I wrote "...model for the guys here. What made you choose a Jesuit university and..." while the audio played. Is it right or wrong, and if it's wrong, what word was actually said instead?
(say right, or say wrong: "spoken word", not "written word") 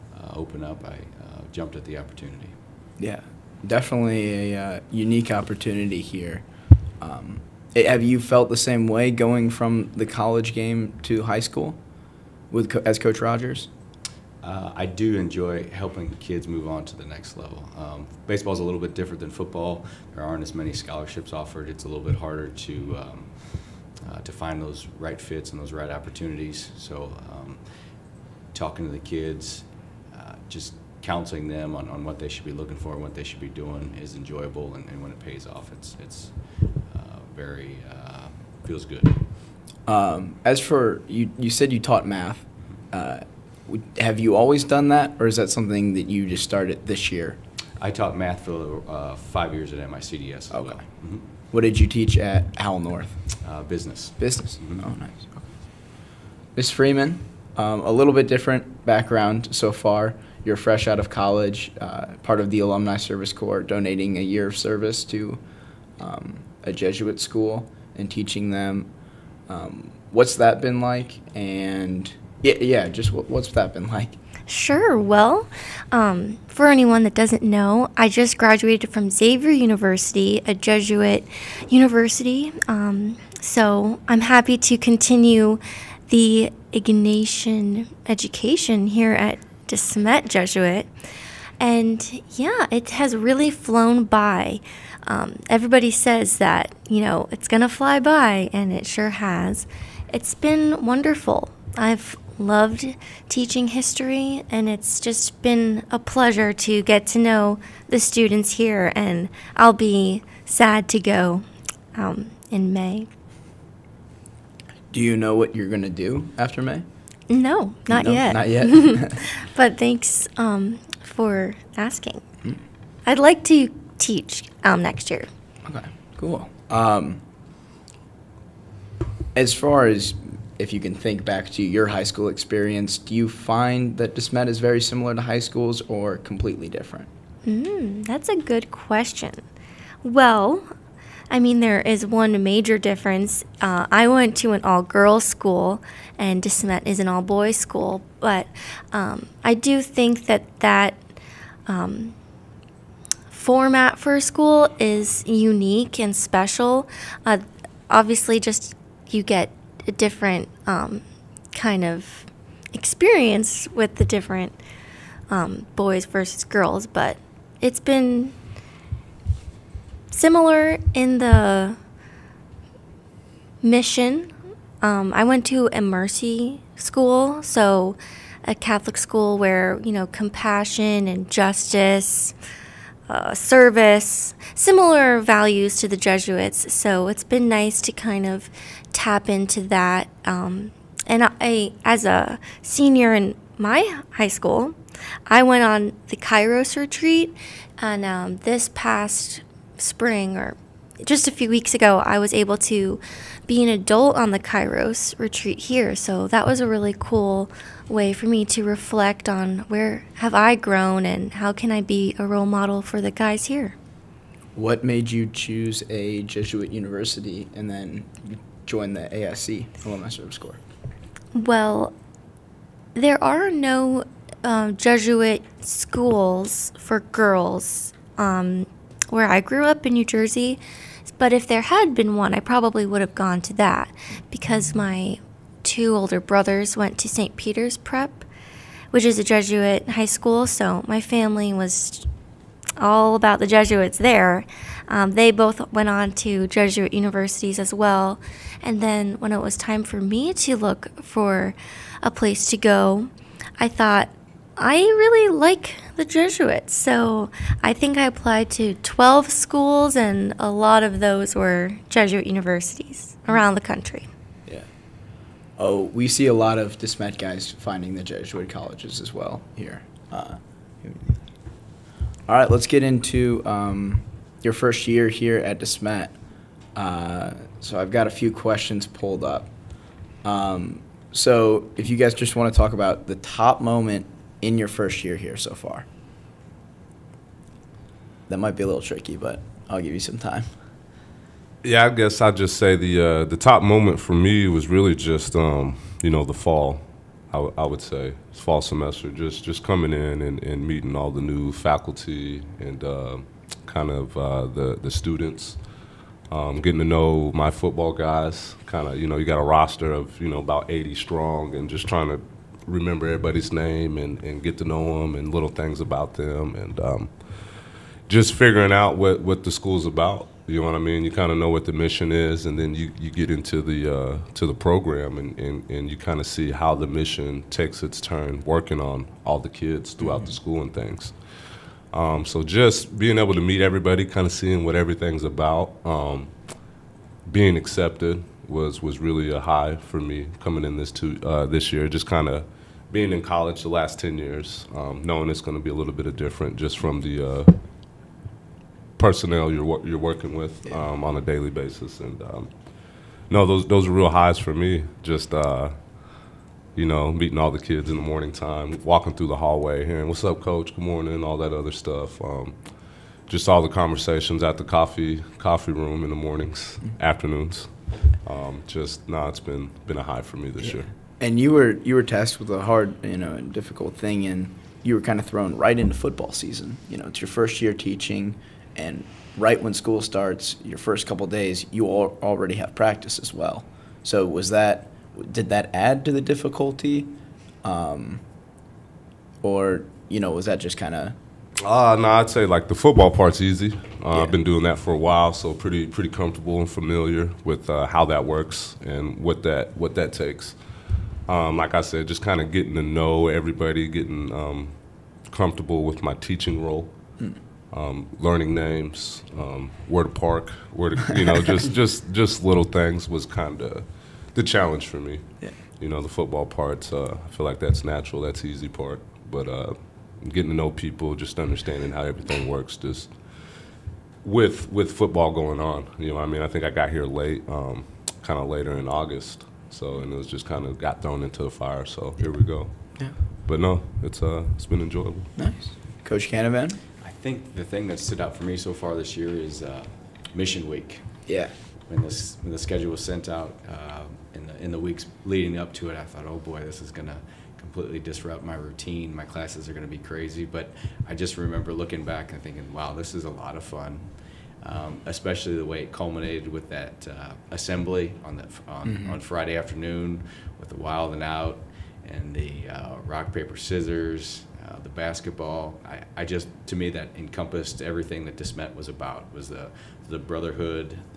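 right.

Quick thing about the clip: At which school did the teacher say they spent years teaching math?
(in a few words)
MICDS.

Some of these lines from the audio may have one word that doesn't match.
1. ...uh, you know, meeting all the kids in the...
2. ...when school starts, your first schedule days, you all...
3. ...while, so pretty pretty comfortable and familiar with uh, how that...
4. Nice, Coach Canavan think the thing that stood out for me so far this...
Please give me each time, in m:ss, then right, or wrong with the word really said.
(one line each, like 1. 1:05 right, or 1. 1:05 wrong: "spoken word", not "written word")
1. 5:55 right
2. 6:19 wrong: "couple", not "schedule"
3. 6:34 right
4. 7:15 right.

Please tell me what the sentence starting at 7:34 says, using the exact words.
Um, especially the way it culminated with that uh, assembly on the on, mm -hmm.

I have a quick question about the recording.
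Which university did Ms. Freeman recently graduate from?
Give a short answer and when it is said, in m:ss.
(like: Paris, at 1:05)
Xavier University, at 1:19.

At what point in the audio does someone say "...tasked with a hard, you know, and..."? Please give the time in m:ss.
6:12.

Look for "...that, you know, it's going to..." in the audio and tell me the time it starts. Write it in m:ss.
1:36.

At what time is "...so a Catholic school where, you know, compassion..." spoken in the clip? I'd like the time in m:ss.
2:57.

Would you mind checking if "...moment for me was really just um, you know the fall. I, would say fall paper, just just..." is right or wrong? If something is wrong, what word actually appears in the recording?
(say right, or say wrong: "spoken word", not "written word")
wrong: "semester", not "paper".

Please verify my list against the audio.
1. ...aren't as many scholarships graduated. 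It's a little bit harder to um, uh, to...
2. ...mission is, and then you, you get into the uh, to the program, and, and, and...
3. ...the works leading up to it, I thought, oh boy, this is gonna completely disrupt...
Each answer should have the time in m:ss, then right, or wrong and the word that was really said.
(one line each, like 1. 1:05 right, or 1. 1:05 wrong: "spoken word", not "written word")
1. 0:20 wrong: "offered", not "graduated"
2. 5:21 right
3. 7:24 wrong: "weeks", not "works".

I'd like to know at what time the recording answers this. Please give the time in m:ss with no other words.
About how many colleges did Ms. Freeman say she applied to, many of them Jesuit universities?
4:18.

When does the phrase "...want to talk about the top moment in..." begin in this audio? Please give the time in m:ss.
4:42.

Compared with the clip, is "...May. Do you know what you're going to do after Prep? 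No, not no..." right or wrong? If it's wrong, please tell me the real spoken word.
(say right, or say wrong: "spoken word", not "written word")
wrong: "May", not "Prep".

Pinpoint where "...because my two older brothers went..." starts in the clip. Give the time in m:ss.
3:54.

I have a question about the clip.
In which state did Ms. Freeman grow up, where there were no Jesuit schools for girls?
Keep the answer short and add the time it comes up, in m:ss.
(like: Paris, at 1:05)
New Jersey, at 3:49.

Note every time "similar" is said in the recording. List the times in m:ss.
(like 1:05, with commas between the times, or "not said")
2:14, 2:50, 3:04.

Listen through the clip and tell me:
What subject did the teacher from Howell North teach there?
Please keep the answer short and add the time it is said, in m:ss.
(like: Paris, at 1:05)
Business, at 0:53.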